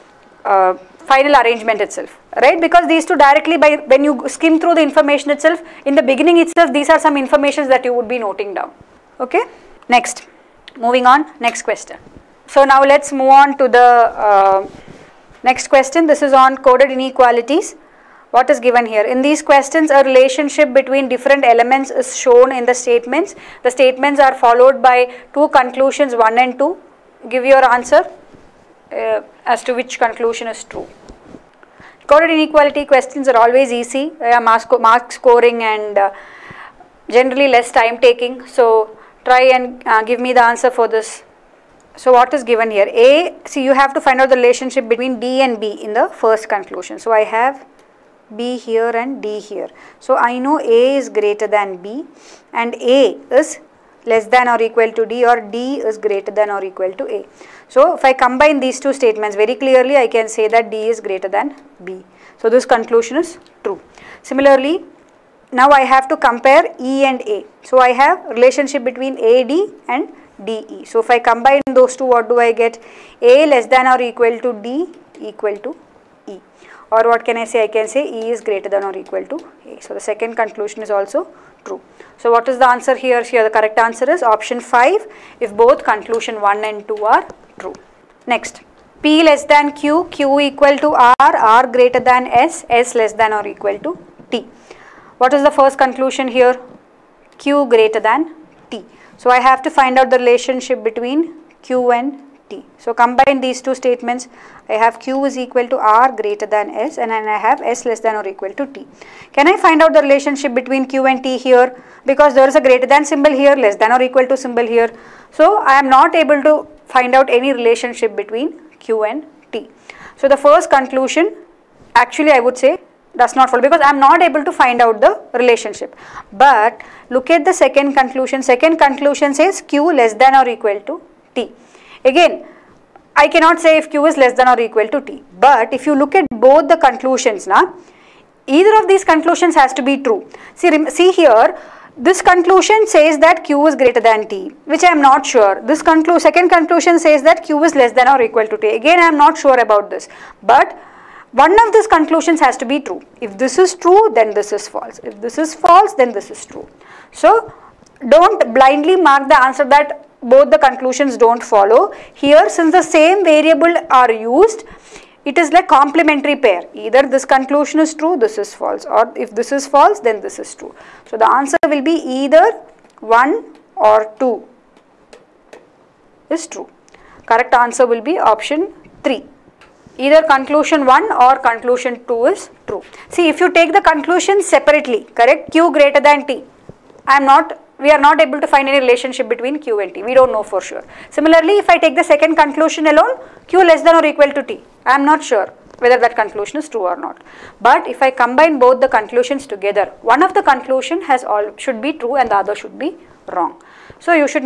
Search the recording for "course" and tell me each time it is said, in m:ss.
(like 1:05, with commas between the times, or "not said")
not said.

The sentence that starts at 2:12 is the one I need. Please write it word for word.
Again, I cannot say if q is less than or equal to t.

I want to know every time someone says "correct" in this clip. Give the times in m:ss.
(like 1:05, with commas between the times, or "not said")
1:23, 2:57, 3:05.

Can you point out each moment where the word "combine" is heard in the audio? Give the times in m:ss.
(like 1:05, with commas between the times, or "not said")
0:58, 1:11, 1:42, 3:18.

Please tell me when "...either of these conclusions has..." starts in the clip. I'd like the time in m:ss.
2:18.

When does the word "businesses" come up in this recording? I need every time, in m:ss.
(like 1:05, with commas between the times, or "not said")
not said.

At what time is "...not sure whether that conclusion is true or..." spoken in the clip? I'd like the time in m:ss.
3:15.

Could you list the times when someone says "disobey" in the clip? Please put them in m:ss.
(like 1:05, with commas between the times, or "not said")
not said.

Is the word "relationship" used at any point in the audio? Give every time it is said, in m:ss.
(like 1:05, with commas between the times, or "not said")
0:20, 0:44, 1:08, 1:40, 1:50, 1:57, 2:05, 3:08.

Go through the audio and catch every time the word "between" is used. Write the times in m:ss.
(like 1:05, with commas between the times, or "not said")
0:20, 0:44, 1:08, 1:40, 1:50, 1:58, 3:09.